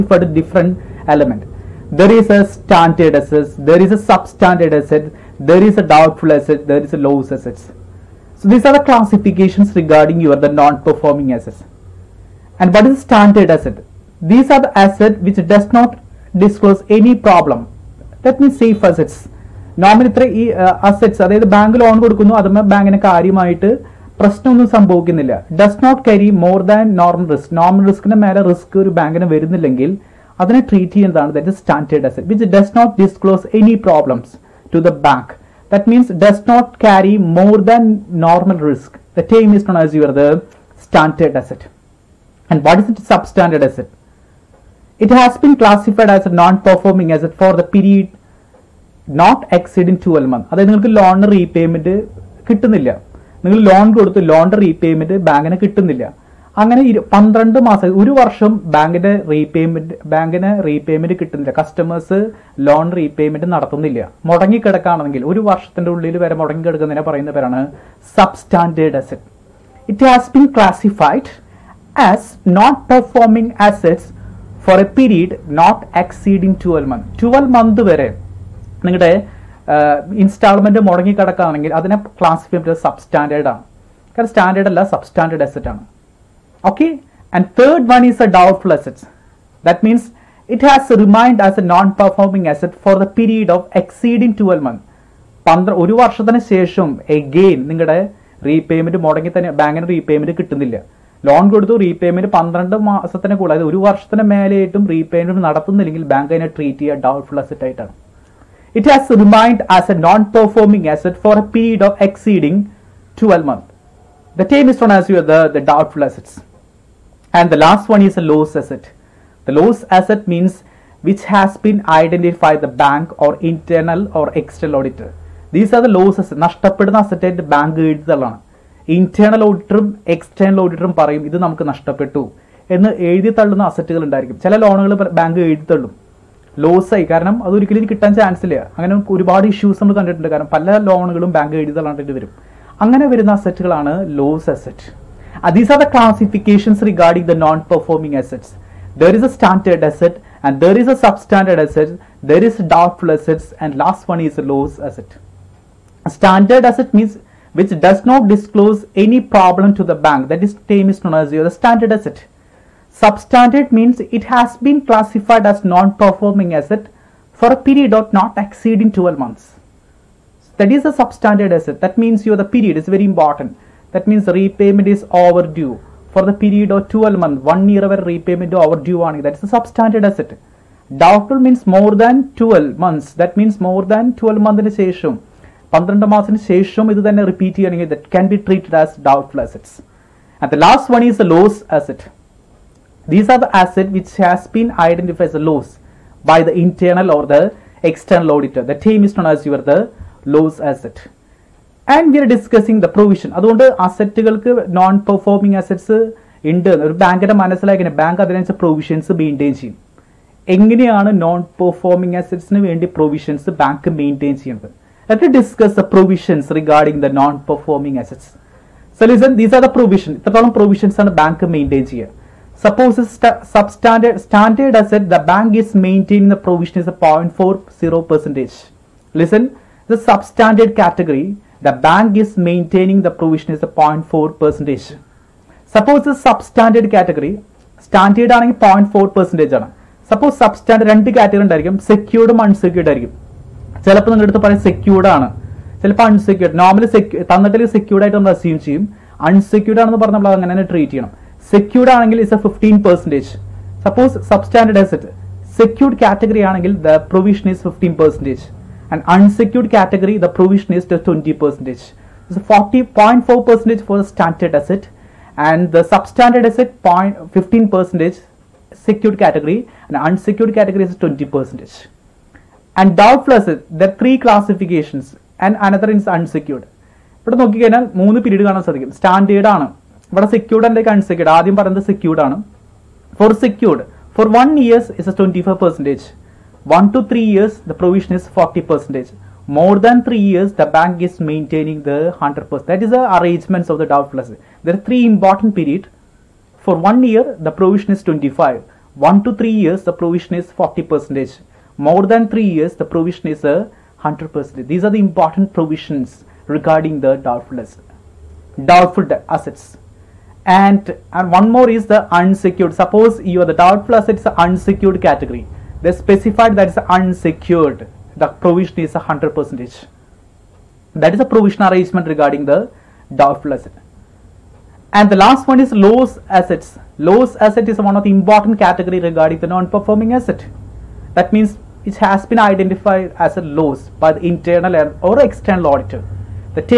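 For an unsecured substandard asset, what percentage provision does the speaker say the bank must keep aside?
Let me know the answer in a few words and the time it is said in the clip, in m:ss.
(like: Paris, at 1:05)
20%, at 4:31.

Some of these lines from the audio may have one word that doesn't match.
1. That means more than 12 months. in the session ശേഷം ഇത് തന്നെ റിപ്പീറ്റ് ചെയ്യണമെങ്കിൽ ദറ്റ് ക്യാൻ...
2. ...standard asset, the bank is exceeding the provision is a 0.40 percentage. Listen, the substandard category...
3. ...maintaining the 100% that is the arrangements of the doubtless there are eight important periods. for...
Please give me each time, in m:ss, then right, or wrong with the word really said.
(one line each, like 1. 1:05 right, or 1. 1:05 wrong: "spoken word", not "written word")
1. 3:03 right
2. 3:44 wrong: "maintaining", not "exceeding"
3. 4:51 wrong: "three", not "eight".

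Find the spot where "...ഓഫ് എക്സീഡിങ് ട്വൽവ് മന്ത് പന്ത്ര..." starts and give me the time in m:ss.
1:33.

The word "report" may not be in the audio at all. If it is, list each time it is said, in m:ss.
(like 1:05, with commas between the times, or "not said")
not said.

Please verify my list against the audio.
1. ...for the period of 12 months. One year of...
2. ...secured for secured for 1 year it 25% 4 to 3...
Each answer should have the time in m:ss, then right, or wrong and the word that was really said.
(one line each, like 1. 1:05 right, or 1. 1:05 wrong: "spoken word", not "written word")
1. 2:56 right
2. 4:41 wrong: "1", not "4".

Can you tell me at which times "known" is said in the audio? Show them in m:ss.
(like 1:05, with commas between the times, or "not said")
1:54, 3:19.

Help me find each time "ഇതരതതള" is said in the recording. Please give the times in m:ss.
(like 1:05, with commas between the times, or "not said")
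3:40.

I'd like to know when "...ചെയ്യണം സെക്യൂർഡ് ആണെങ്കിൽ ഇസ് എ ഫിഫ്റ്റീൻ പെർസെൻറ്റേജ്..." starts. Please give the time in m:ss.
4:10.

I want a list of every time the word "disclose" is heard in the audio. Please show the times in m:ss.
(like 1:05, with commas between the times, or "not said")
0:16.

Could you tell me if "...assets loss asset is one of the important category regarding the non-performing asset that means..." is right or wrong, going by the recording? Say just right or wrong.
right.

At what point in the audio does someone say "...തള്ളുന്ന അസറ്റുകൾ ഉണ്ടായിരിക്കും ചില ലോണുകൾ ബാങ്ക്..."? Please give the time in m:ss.
2:13.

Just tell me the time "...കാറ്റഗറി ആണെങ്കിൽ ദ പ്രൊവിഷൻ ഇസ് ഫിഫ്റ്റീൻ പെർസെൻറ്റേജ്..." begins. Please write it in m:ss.
4:16.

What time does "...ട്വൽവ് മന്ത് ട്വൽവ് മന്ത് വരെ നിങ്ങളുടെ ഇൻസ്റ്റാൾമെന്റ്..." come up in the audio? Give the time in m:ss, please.
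1:16.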